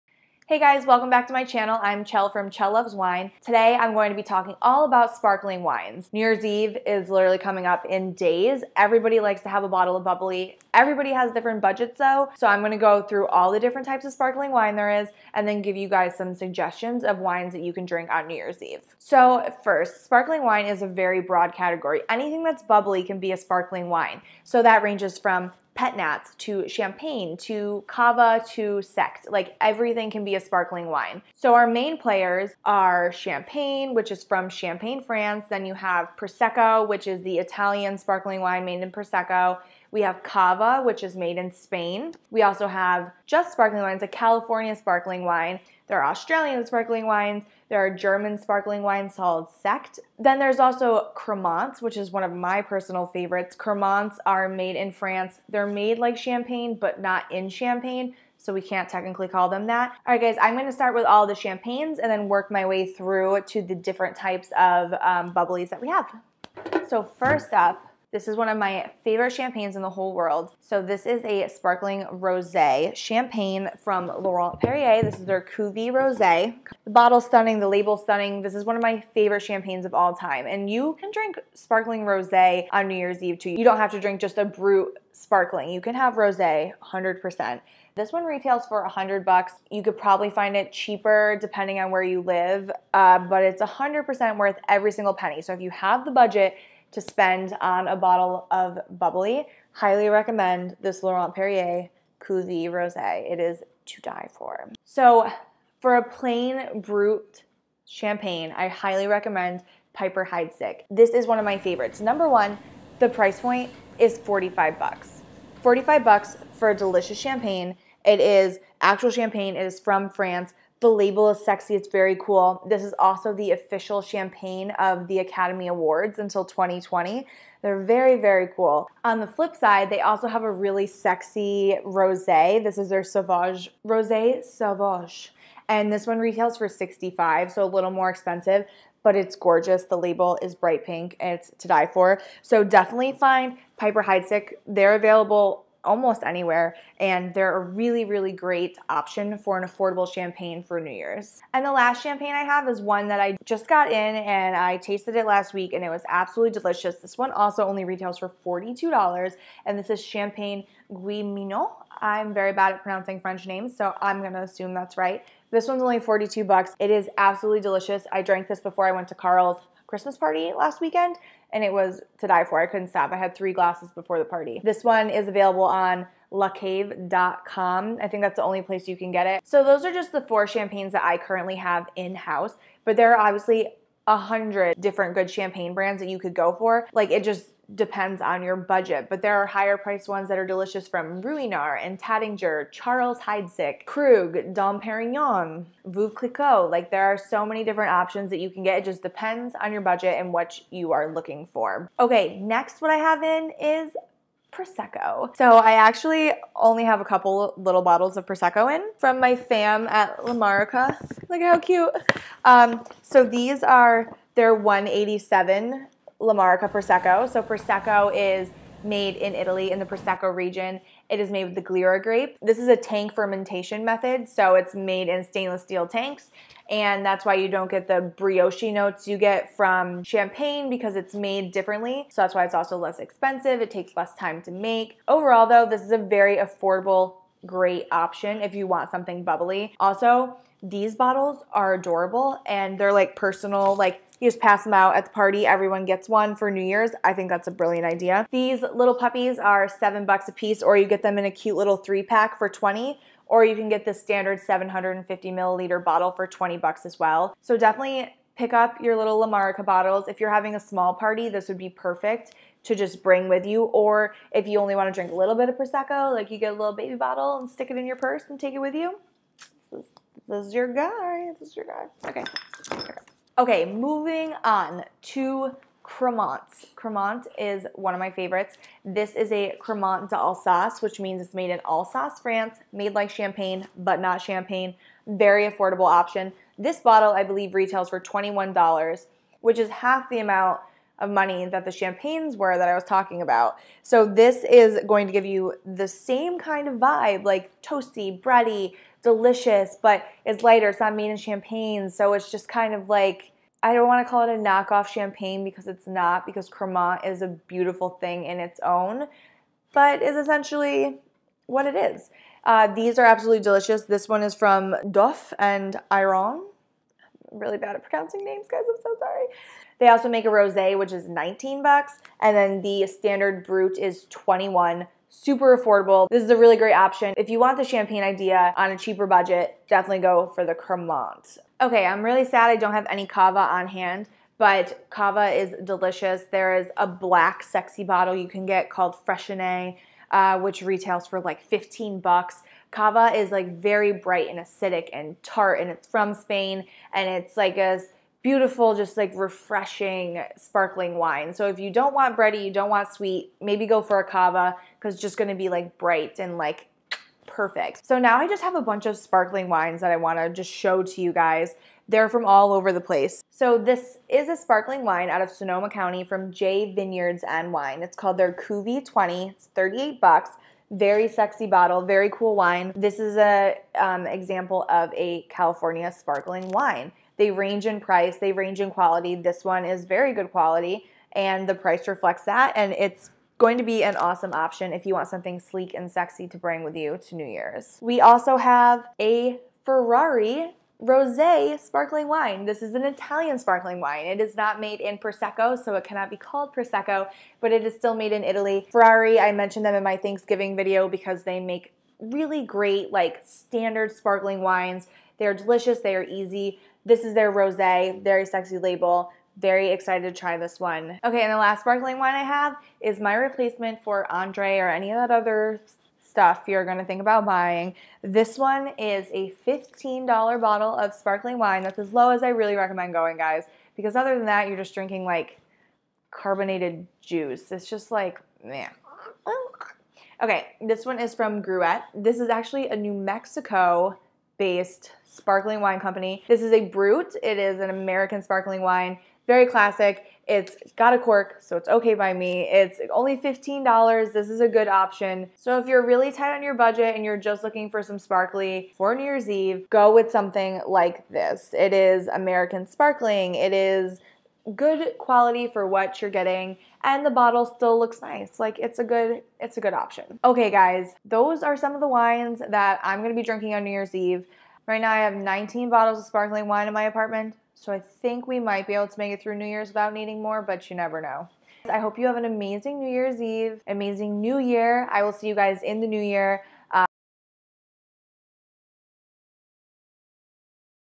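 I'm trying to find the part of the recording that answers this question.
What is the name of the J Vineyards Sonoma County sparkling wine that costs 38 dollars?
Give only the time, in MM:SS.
06:08.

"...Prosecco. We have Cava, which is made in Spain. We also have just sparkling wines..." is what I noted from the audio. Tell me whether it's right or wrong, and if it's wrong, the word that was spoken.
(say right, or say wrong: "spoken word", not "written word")
right.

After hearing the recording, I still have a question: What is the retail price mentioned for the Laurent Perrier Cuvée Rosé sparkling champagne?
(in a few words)
$100.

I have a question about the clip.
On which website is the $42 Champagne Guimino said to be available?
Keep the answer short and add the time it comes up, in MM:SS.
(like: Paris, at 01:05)
lacave.com, at 02:56.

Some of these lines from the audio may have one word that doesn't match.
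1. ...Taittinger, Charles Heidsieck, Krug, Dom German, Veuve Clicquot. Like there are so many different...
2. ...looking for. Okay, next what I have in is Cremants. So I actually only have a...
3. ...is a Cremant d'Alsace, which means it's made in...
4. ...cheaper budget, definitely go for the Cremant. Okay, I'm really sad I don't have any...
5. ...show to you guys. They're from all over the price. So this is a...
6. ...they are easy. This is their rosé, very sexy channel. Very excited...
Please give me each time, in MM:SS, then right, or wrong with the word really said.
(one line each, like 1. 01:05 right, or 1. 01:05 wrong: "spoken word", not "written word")
1. 03:11 wrong: "Perignon", not "German"
2. 03:21 wrong: "Prosecco", not "Cremants"
3. 04:39 right
4. 05:28 right
5. 06:00 wrong: "place", not "price"
6. 06:45 wrong: "label", not "channel".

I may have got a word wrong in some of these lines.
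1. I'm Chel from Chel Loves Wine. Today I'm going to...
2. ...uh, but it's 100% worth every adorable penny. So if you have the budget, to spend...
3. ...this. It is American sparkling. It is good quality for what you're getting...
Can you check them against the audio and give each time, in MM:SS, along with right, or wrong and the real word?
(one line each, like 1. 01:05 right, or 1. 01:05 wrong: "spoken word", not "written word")
1. 00:01 right
2. 01:32 wrong: "single", not "adorable"
3. 07:31 right.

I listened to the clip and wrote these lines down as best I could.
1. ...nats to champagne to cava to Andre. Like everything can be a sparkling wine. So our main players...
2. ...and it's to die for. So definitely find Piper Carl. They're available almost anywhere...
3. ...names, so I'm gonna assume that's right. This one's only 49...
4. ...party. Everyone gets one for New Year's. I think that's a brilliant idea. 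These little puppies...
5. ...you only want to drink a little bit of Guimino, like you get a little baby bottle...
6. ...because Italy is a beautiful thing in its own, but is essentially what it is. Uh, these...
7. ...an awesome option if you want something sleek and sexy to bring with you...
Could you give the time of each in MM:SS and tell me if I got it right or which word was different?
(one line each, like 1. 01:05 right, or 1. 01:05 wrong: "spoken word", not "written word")
1. 00:25 wrong: "Sekt", not "Andre"
2. 02:21 wrong: "Heidsieck", not "Carl"
3. 02:43 wrong: "42", not "49"
4. 04:05 right
5. 04:24 wrong: "Prosecco", not "Guimino"
6. 05:06 wrong: "Cremant", not "Italy"
7. 06:23 right.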